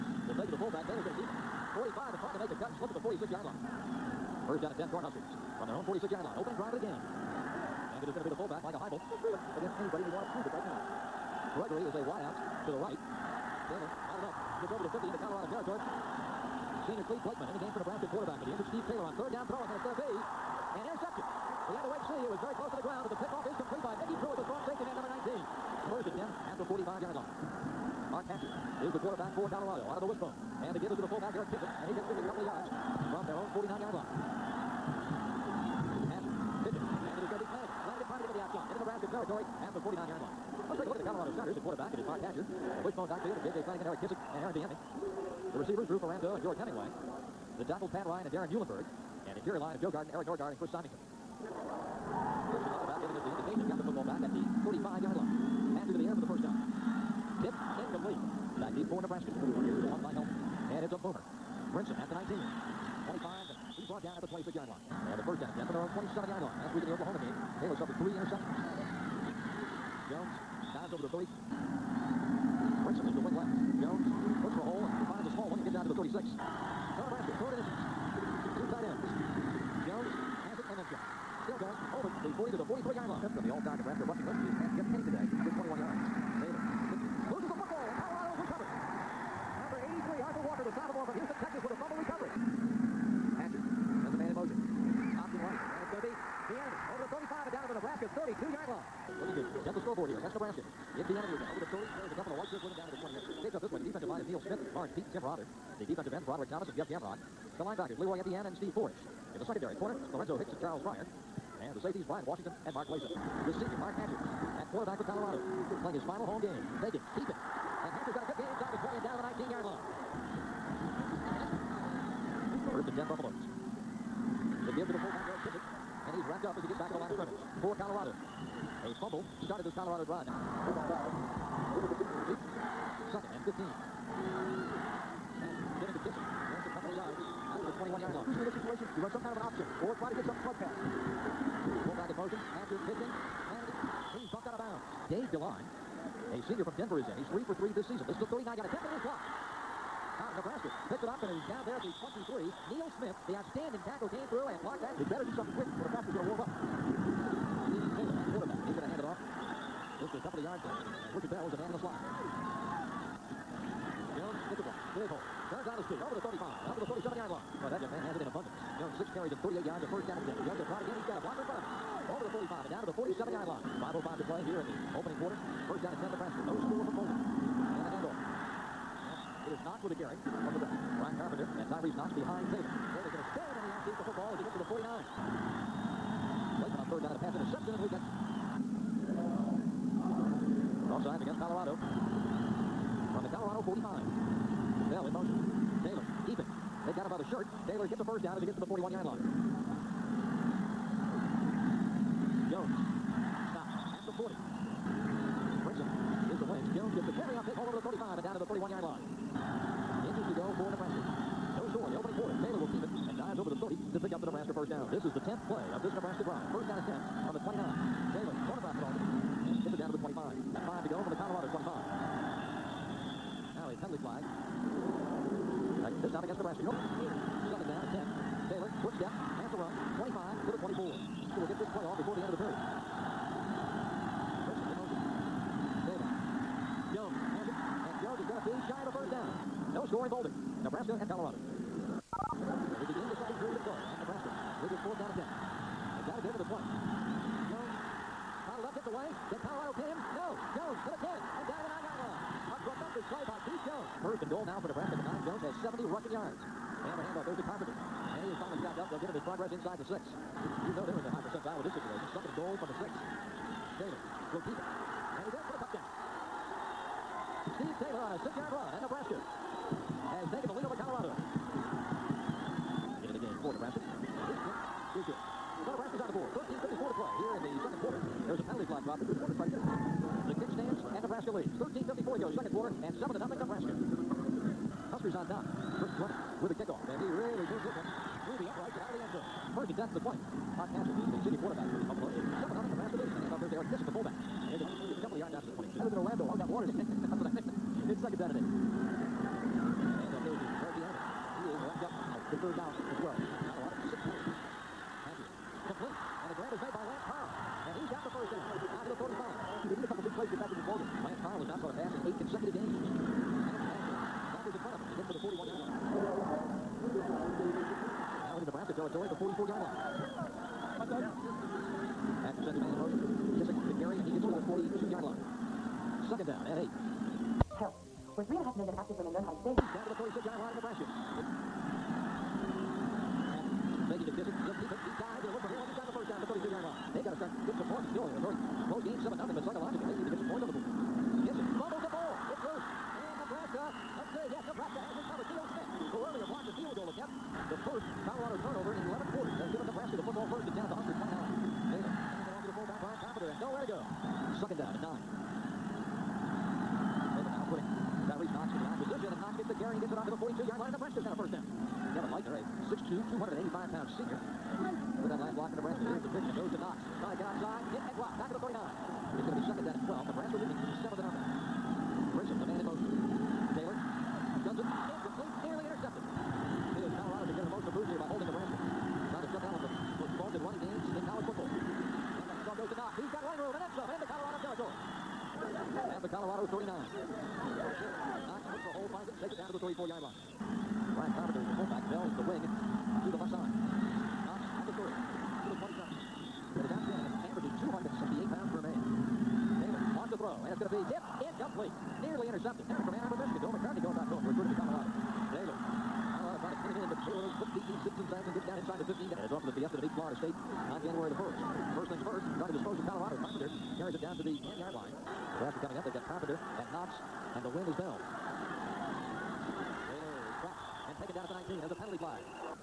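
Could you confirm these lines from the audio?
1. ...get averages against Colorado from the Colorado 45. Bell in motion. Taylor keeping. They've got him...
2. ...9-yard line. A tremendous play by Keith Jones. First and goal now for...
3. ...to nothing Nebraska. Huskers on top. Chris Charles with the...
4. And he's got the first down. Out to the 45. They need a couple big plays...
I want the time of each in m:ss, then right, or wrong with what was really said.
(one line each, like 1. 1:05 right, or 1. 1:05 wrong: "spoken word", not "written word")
1. 3:07 wrong: "offsides", not "averages"
2. 4:11 right
3. 4:43 wrong: "Drummond", not "Charles"
4. 5:07 right.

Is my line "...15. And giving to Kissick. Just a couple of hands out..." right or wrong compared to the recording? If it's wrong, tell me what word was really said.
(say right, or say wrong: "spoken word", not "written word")
wrong: "yards", not "hands".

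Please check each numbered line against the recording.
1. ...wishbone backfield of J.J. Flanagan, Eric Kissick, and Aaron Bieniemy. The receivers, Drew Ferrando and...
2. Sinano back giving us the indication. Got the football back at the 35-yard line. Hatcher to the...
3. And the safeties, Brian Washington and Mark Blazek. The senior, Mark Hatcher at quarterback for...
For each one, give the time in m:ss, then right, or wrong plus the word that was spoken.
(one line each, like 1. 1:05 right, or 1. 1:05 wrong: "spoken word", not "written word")
1. 0:42 right
2. 0:52 right
3. 1:51 right.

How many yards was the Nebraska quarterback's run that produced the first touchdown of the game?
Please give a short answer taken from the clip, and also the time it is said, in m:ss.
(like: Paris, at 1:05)
6, at 4:28.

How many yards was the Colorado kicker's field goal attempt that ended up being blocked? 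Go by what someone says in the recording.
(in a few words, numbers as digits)
39.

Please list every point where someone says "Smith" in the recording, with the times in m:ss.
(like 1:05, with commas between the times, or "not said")
1:44, 2:32, 5:45.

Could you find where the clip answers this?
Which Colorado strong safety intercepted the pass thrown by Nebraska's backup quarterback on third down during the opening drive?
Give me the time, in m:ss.
0:24.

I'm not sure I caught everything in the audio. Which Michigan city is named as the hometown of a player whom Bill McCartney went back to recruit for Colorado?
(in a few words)
Ann Arbor.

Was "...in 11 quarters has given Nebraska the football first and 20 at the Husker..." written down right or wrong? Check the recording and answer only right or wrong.
wrong.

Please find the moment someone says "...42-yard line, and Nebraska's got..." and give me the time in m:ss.
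6:00.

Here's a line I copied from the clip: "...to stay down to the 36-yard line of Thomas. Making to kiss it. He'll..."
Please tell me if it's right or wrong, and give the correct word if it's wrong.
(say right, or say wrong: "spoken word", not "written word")
wrong: "Nebraska", not "Thomas".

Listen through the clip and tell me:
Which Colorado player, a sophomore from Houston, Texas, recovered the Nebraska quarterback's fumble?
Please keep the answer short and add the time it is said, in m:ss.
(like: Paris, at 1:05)
Arthur Walker, at 1:30.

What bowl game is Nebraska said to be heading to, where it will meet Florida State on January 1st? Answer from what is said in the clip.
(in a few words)
Fiesta.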